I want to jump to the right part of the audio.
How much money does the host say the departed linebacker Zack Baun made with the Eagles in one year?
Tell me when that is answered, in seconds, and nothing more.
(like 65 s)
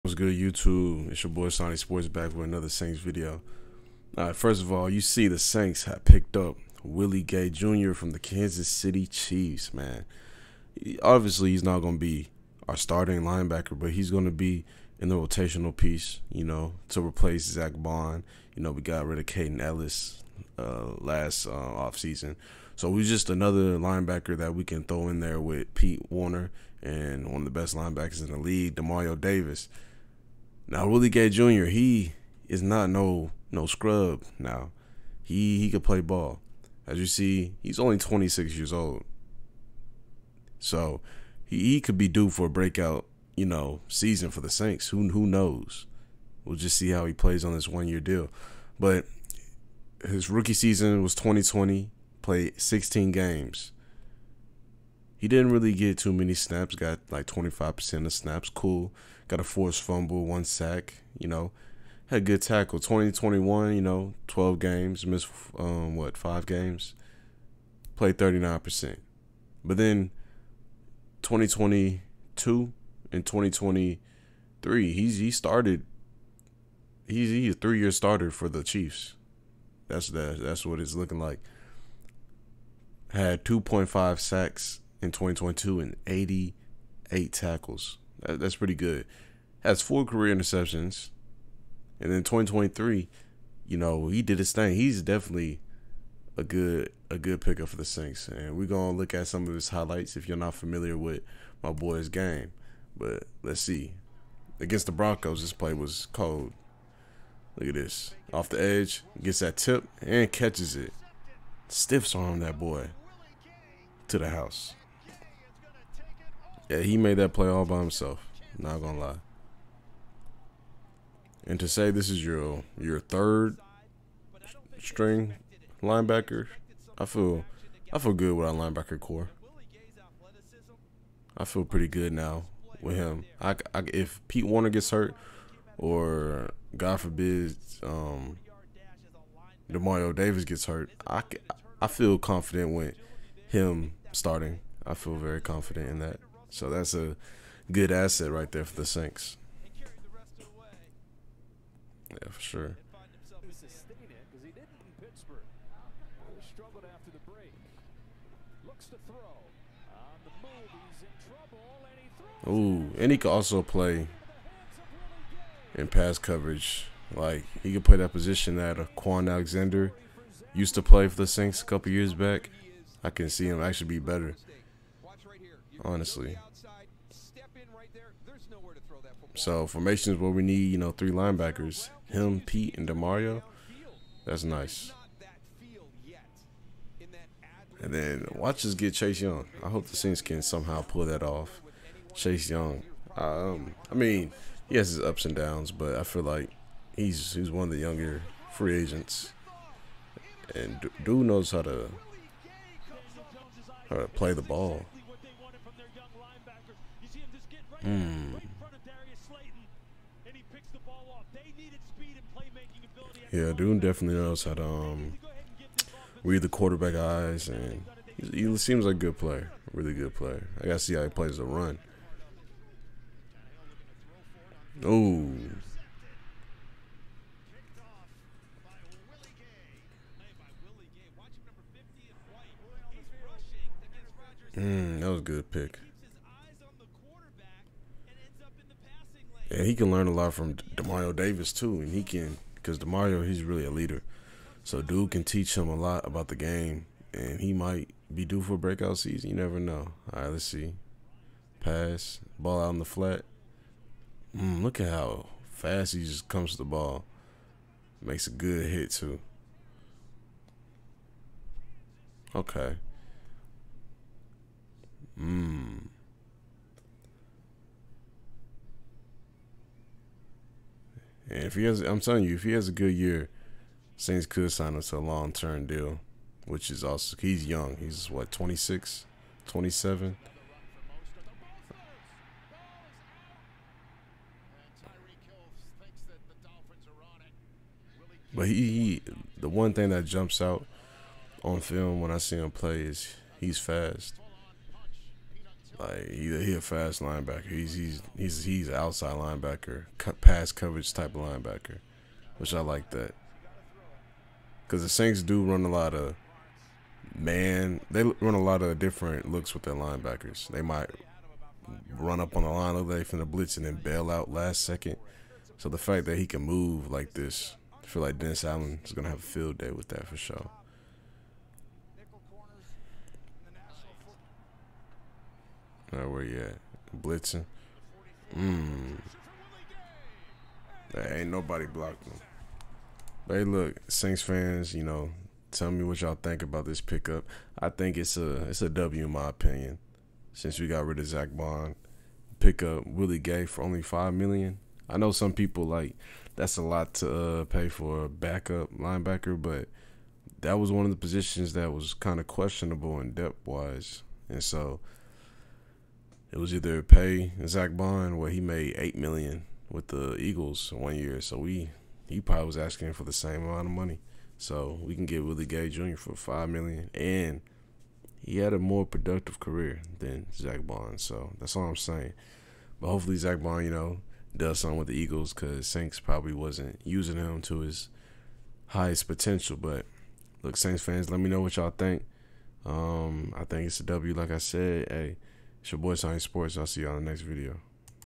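358 s.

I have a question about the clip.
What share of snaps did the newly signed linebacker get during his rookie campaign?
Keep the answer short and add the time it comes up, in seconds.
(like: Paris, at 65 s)
25%, at 57 s.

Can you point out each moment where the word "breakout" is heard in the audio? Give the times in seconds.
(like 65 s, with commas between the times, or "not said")
42 s, 248 s.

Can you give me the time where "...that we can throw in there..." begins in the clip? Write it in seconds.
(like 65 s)
24 s.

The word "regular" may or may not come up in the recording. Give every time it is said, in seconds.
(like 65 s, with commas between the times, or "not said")
not said.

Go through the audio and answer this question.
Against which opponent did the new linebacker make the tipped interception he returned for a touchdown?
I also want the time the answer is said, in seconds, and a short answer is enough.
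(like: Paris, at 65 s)
Broncos, at 104 s.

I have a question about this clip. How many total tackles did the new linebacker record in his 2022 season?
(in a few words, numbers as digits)
88.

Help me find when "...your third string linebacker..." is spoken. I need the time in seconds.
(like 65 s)
122 s.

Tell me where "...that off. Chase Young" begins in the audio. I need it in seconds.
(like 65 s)
191 s.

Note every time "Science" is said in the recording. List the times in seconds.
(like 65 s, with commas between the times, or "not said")
385 s.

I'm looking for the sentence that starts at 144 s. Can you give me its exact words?
I feel very confident in that.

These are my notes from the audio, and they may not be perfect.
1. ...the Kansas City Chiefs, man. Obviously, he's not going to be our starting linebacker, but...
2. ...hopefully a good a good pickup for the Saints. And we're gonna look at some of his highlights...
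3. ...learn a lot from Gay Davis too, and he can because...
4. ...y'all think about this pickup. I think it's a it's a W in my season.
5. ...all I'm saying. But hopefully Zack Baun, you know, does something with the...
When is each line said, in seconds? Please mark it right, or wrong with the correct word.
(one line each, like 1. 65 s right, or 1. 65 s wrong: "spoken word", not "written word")
1. 8 s right
2. 95 s wrong: "definitely", not "hopefully"
3. 239 s wrong: "Demario", not "Gay"
4. 336 s wrong: "opinion", not "season"
5. 371 s right.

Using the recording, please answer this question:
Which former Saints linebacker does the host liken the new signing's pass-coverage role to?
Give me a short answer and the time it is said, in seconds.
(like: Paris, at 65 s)
Kwon Alexander, at 168 s.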